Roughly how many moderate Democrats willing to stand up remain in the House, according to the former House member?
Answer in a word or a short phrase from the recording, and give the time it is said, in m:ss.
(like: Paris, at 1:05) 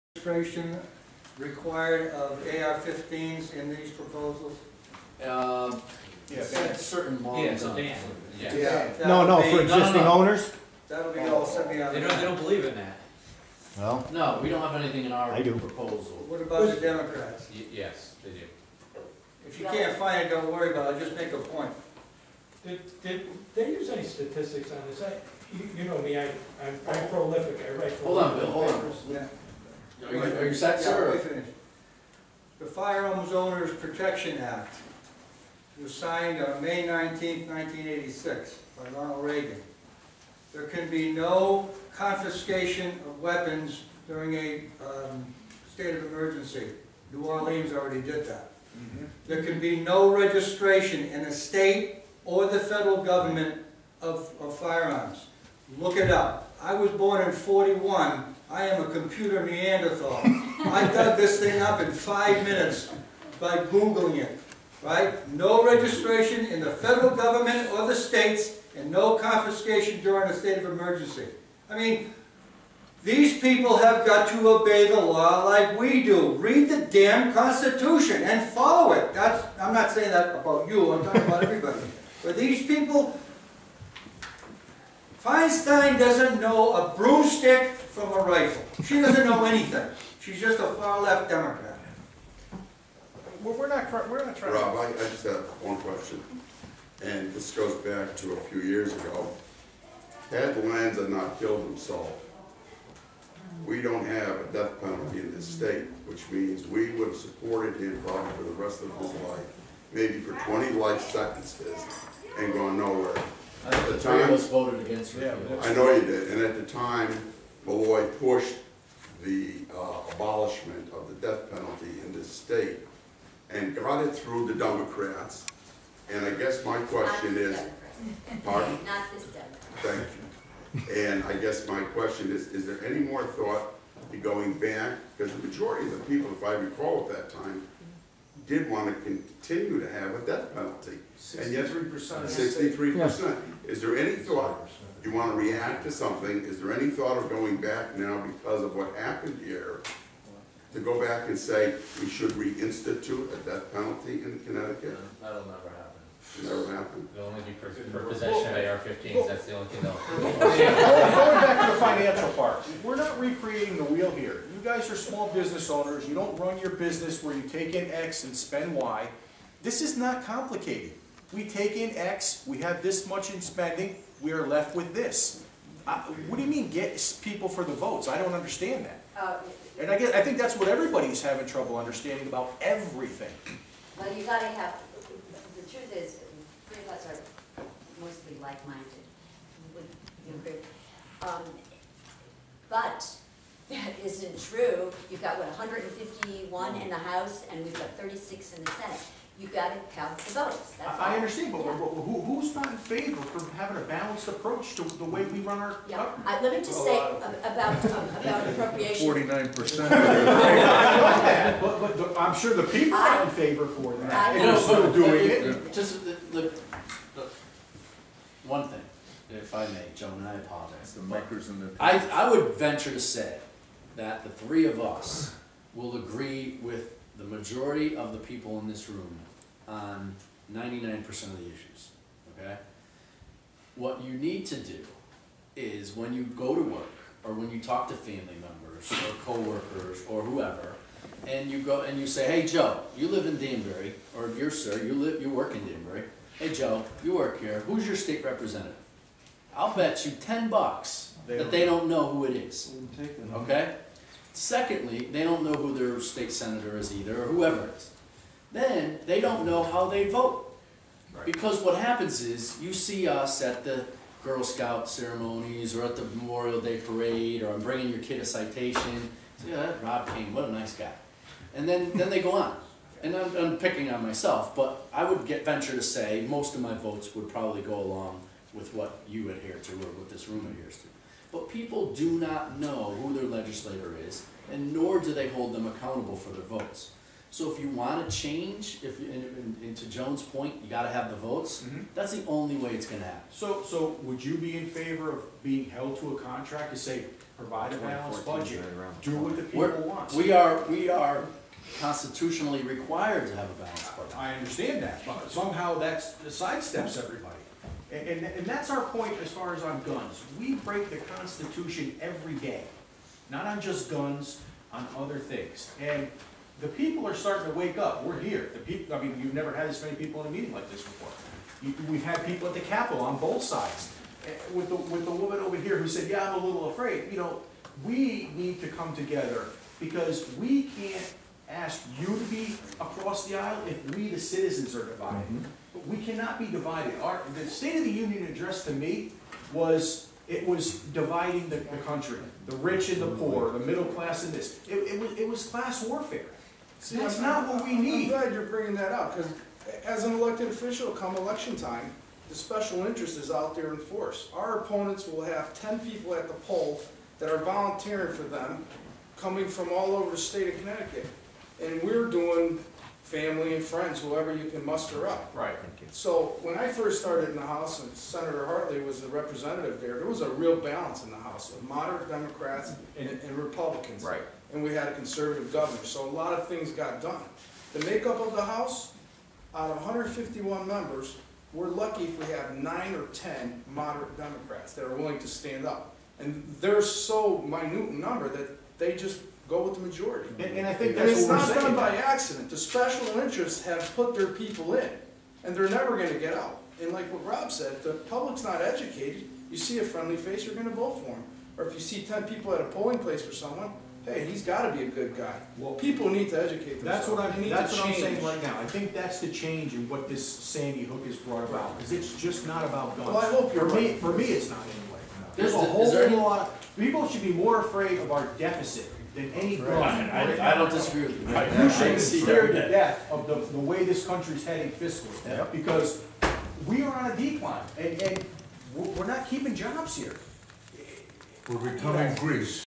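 9 or 10, at 6:22.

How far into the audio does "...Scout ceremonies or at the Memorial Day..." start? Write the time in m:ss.
4:24.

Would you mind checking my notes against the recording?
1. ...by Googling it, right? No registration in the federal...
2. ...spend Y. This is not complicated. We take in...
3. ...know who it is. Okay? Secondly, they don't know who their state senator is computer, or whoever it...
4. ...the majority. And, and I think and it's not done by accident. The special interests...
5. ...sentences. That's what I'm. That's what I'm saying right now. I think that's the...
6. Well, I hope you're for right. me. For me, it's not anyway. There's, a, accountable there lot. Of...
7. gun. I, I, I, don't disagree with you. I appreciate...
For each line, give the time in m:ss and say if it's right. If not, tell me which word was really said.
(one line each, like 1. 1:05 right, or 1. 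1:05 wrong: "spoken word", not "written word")
1. 1:03 right
2. 2:48 right
3. 4:11 wrong: "either", not "computer"
4. 6:29 right
5. 6:46 wrong: "themselves", not "sentences"
6. 6:53 wrong: "whole", not "accountable"
7. 6:59 right.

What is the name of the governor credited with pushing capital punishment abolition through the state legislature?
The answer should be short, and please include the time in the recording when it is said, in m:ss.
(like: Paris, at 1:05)
Malloy, at 1:57.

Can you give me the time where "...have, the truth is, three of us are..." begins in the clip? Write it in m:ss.
3:04.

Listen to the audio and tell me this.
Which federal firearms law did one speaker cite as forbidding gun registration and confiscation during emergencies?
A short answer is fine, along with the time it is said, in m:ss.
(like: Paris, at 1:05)
Firearms Owners Protection Act, at 0:32.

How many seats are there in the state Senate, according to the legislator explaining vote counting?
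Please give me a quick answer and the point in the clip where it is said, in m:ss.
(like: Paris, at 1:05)
36, at 3:17.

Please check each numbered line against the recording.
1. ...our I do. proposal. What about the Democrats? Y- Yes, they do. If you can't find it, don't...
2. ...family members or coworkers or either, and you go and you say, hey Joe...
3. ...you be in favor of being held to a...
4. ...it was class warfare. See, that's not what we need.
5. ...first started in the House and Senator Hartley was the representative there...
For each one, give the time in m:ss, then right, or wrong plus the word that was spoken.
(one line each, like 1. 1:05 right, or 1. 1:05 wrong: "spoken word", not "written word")
1. 0:15 right
2. 3:57 wrong: "whoever", not "either"
3. 4:54 right
4. 5:45 right
5. 6:06 right.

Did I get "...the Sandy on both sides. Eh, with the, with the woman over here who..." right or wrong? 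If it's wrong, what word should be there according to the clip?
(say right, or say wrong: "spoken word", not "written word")
wrong: "Capitol", not "Sandy".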